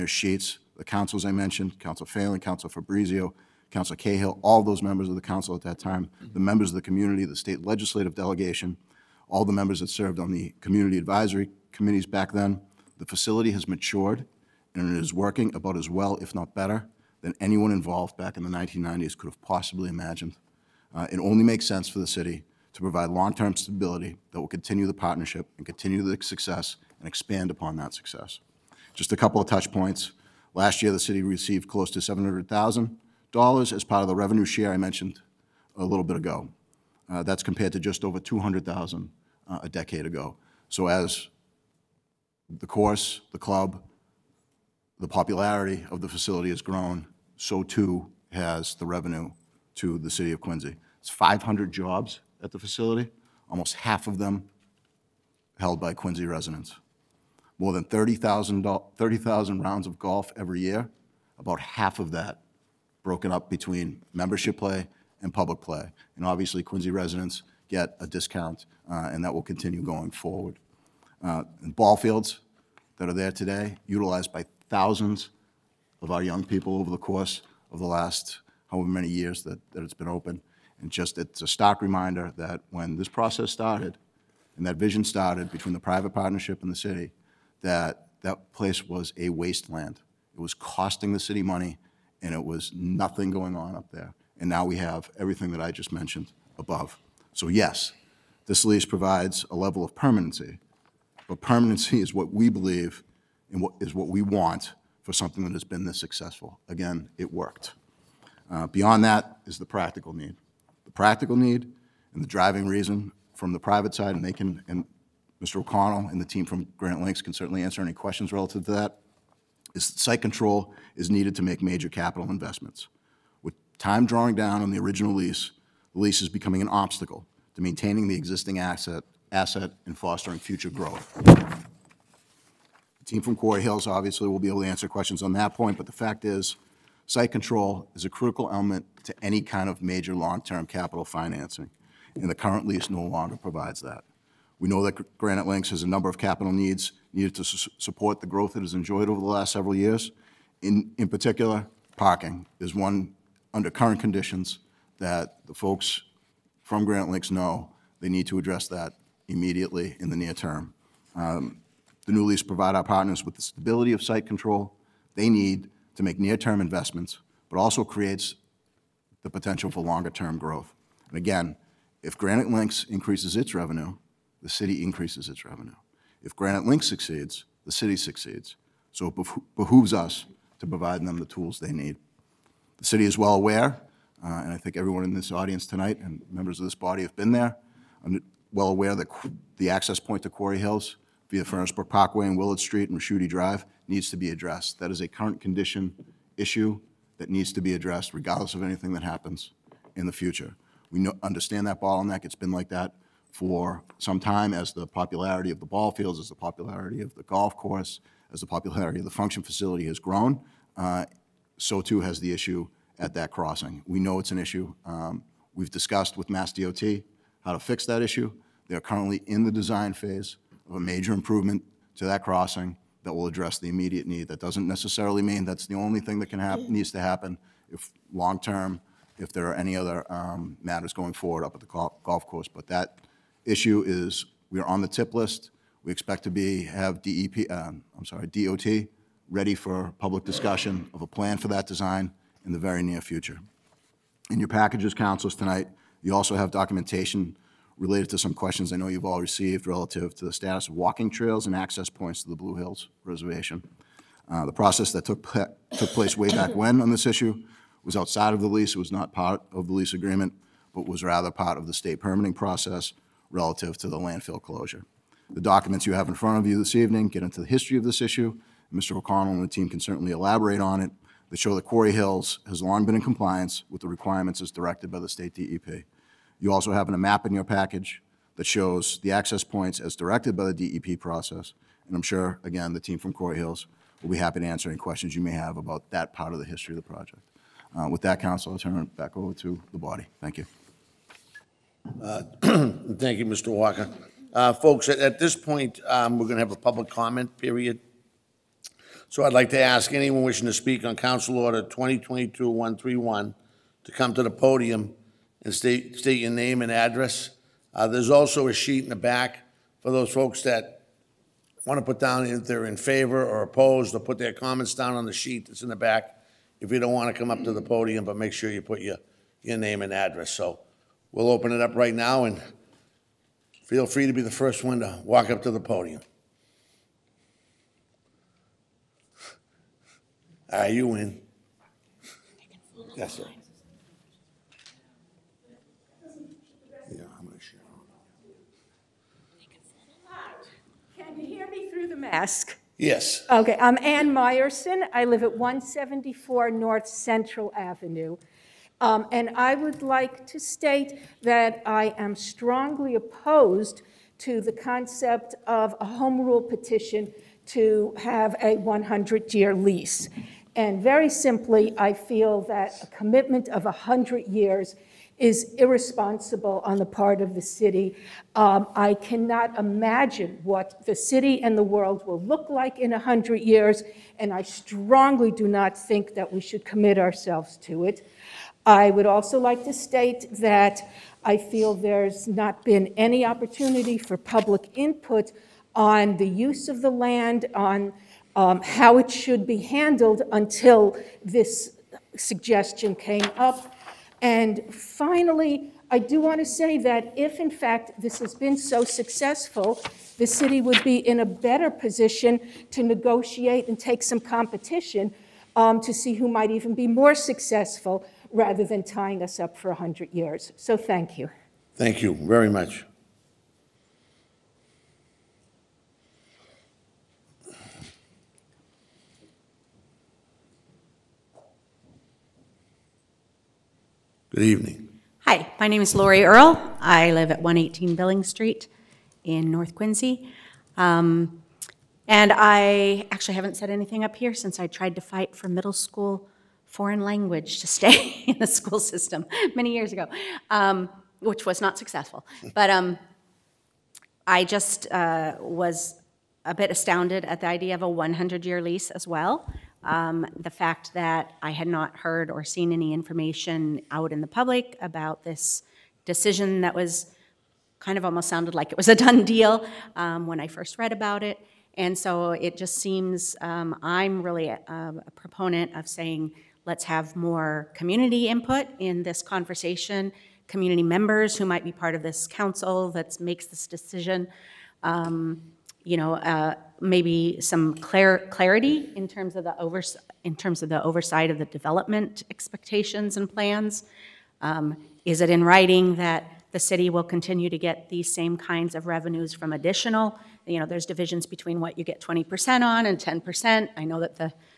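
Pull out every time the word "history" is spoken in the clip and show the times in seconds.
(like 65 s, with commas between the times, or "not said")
267 s, 286 s.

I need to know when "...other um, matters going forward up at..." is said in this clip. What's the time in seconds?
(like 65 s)
229 s.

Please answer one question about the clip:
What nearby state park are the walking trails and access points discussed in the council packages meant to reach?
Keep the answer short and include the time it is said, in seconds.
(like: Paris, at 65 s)
Blue Hills Reservation, at 252 s.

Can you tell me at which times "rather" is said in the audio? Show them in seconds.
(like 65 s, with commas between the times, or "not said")
261 s, 408 s.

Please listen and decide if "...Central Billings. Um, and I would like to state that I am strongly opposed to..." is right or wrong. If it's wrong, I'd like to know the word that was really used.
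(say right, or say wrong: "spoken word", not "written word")
wrong: "Avenue", not "Billings".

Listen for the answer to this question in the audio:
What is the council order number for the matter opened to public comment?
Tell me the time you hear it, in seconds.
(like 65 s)
301 s.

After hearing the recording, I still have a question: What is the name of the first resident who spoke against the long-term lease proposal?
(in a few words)
Ann Meyerson.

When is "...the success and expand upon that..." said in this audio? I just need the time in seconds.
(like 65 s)
26 s.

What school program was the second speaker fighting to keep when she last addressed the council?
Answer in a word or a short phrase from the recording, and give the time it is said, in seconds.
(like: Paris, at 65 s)
middle school foreign language, at 435 s.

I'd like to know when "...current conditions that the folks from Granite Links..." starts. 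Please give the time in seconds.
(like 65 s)
153 s.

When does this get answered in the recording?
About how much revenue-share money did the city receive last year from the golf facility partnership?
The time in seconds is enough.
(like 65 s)
31 s.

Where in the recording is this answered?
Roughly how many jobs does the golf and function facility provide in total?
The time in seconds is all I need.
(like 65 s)
51 s.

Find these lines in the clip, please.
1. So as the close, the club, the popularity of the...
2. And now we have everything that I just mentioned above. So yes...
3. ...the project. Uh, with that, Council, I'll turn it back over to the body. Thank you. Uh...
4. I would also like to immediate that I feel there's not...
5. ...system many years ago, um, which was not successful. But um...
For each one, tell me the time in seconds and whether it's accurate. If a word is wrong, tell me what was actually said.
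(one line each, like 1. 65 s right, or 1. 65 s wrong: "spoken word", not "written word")
1. 40 s wrong: "course", not "close"
2. 94 s right
3. 286 s right
4. 378 s wrong: "state", not "immediate"
5. 438 s right.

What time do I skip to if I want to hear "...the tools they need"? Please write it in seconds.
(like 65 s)
181 s.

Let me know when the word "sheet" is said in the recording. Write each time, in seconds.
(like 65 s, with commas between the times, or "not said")
0 s, 308 s, 315 s.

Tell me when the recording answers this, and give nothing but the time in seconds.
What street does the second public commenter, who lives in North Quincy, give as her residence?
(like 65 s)
427 s.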